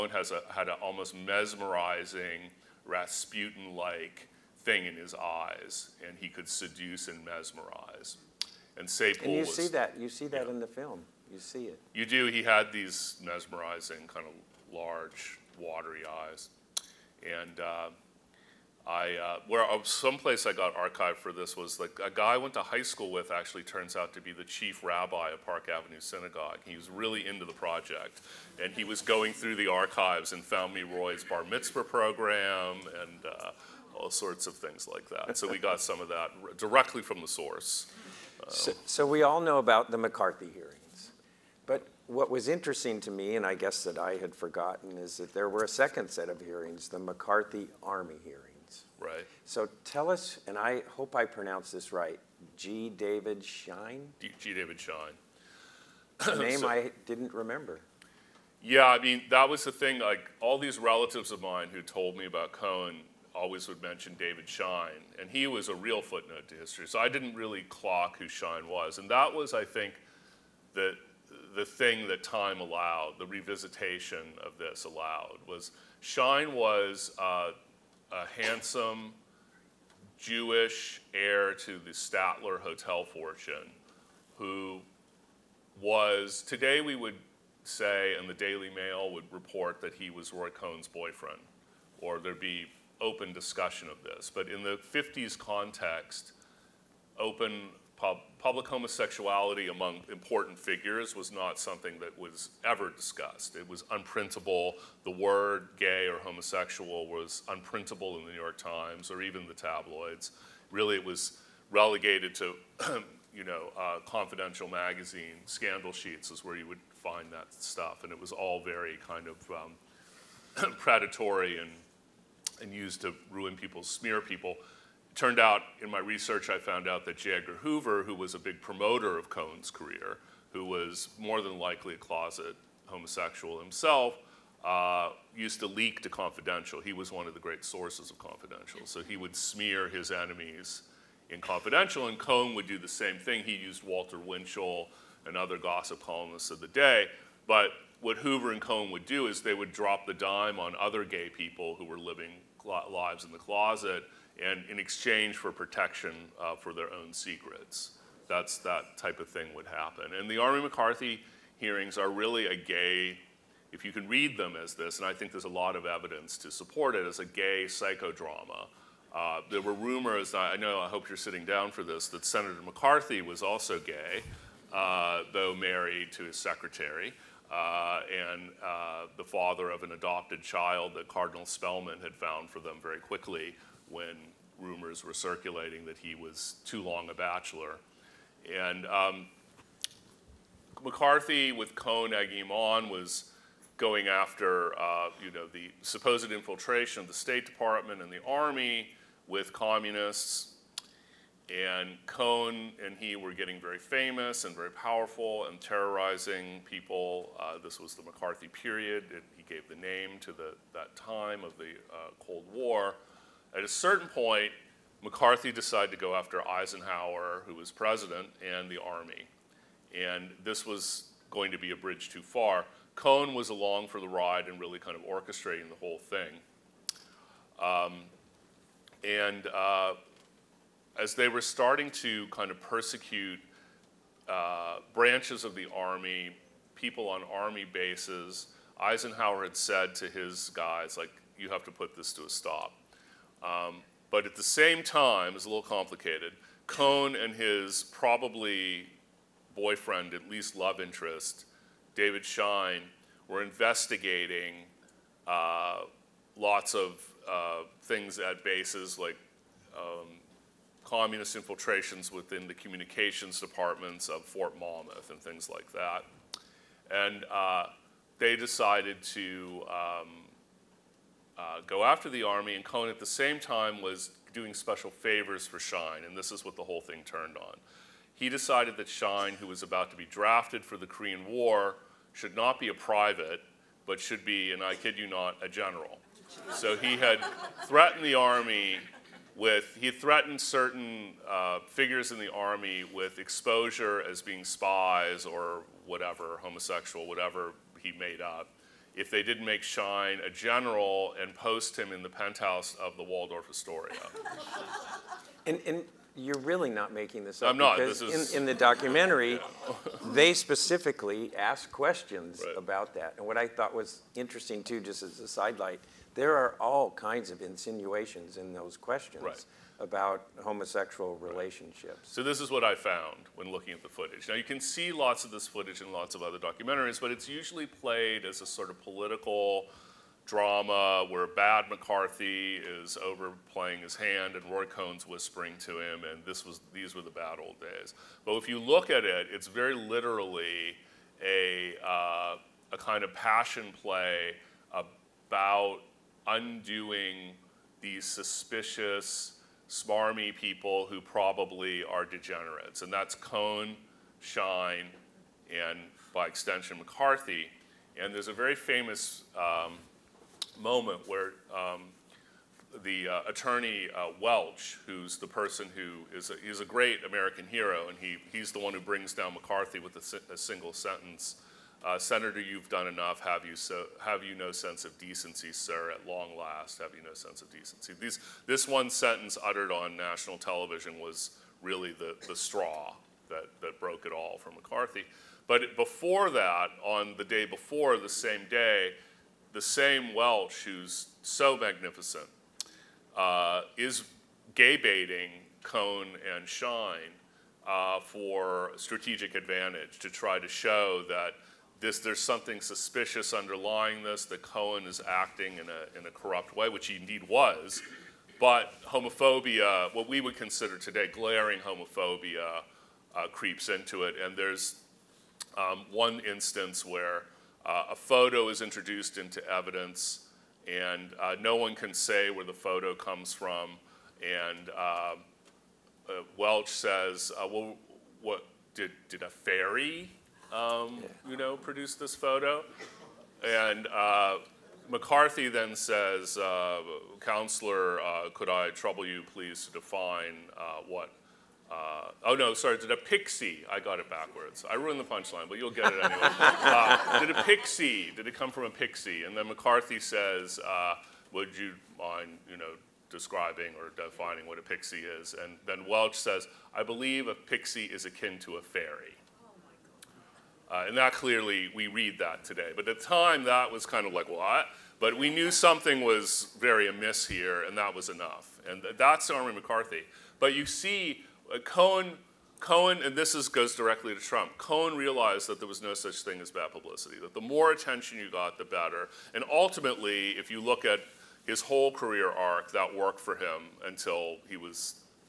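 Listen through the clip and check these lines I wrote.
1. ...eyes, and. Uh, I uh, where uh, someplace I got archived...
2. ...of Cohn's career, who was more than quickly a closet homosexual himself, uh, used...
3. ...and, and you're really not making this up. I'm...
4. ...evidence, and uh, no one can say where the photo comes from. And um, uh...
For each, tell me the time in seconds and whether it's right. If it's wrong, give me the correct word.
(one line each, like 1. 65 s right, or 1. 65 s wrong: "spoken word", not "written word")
1. 16 s right
2. 129 s wrong: "likely", not "quickly"
3. 305 s right
4. 419 s right.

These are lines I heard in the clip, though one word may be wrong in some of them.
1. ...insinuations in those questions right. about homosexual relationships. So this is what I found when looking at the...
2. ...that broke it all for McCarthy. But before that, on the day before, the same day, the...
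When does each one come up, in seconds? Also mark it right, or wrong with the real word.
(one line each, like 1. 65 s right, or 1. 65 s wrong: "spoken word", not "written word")
1. 317 s right
2. 383 s right.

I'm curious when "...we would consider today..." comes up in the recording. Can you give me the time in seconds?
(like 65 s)
410 s.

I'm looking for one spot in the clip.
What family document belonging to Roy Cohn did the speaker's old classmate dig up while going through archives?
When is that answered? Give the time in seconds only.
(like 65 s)
31 s.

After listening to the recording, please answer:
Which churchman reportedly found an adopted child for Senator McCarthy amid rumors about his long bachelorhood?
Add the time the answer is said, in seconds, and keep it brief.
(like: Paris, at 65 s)
Cardinal Spellman, at 181 s.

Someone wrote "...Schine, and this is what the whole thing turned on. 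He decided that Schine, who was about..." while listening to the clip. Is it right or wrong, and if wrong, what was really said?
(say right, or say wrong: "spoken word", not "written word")
right.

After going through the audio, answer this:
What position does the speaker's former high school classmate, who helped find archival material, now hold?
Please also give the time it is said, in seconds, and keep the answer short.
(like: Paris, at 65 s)
Chief rabbi of Park Avenue Synagogue, at 24 s.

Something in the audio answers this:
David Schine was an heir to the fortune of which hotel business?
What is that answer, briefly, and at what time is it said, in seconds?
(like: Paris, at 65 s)
Statler, at 81 s.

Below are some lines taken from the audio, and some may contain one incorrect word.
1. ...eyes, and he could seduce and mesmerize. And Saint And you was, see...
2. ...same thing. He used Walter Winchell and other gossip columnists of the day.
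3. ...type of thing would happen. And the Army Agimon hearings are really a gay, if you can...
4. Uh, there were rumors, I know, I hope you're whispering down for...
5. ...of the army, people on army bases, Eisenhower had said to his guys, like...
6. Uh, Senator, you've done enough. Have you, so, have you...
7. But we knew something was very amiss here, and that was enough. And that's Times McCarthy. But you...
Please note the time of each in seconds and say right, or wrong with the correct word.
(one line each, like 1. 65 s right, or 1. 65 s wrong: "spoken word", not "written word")
1. 5 s right
2. 142 s right
3. 158 s wrong: "McCarthy", not "Agimon"
4. 169 s wrong: "sitting", not "whispering"
5. 235 s right
6. 371 s right
7. 464 s wrong: "Army", not "Times".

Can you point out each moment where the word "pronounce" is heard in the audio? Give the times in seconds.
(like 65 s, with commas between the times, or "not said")
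51 s.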